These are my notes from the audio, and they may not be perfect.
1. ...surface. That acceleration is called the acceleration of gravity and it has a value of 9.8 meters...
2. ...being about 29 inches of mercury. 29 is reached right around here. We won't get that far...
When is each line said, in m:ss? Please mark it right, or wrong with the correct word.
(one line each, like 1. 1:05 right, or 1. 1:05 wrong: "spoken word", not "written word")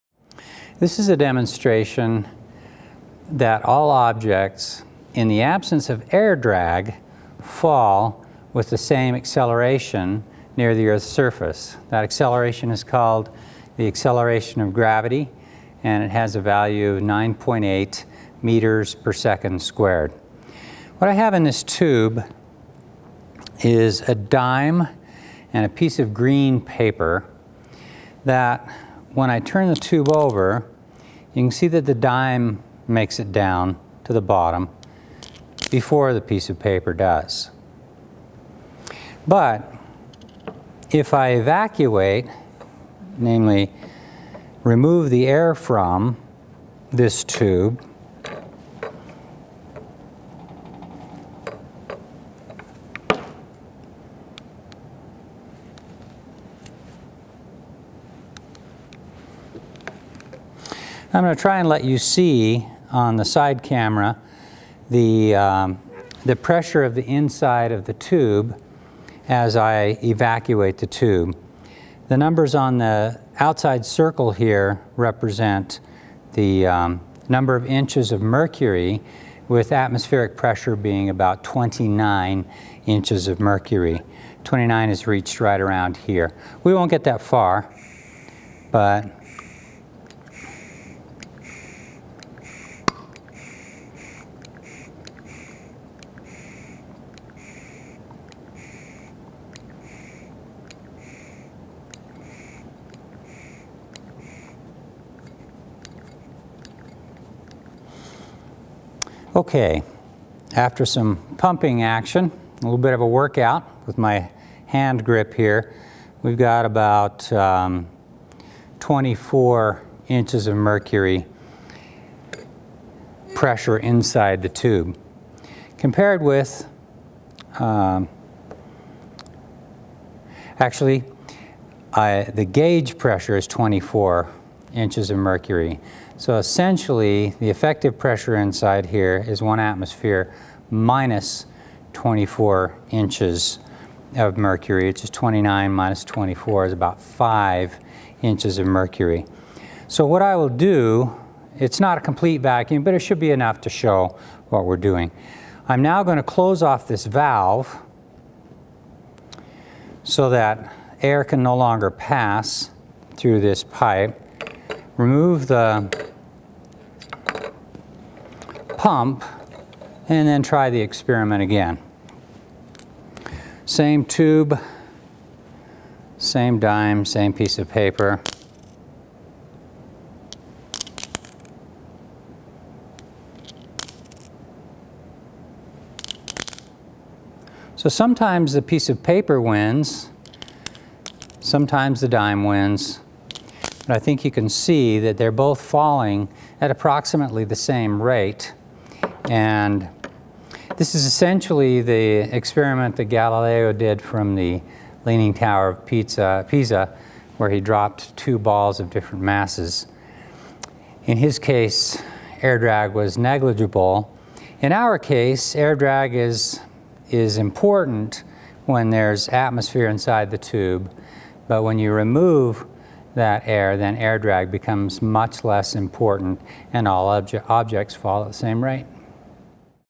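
1. 0:11 right
2. 1:20 right.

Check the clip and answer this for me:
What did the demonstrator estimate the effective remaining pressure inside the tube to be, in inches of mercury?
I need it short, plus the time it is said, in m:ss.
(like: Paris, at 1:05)
5 inches of mercury, at 2:27.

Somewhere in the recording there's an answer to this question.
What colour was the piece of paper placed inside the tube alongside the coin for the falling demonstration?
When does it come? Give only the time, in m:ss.
0:26.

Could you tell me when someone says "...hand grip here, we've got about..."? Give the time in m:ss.
1:54.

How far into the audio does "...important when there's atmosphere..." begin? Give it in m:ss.
3:37.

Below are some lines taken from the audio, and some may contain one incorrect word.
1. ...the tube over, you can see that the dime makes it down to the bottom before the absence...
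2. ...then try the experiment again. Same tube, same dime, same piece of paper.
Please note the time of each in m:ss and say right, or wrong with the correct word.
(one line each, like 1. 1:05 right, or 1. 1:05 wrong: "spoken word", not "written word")
1. 0:29 wrong: "piece", not "absence"
2. 2:50 right.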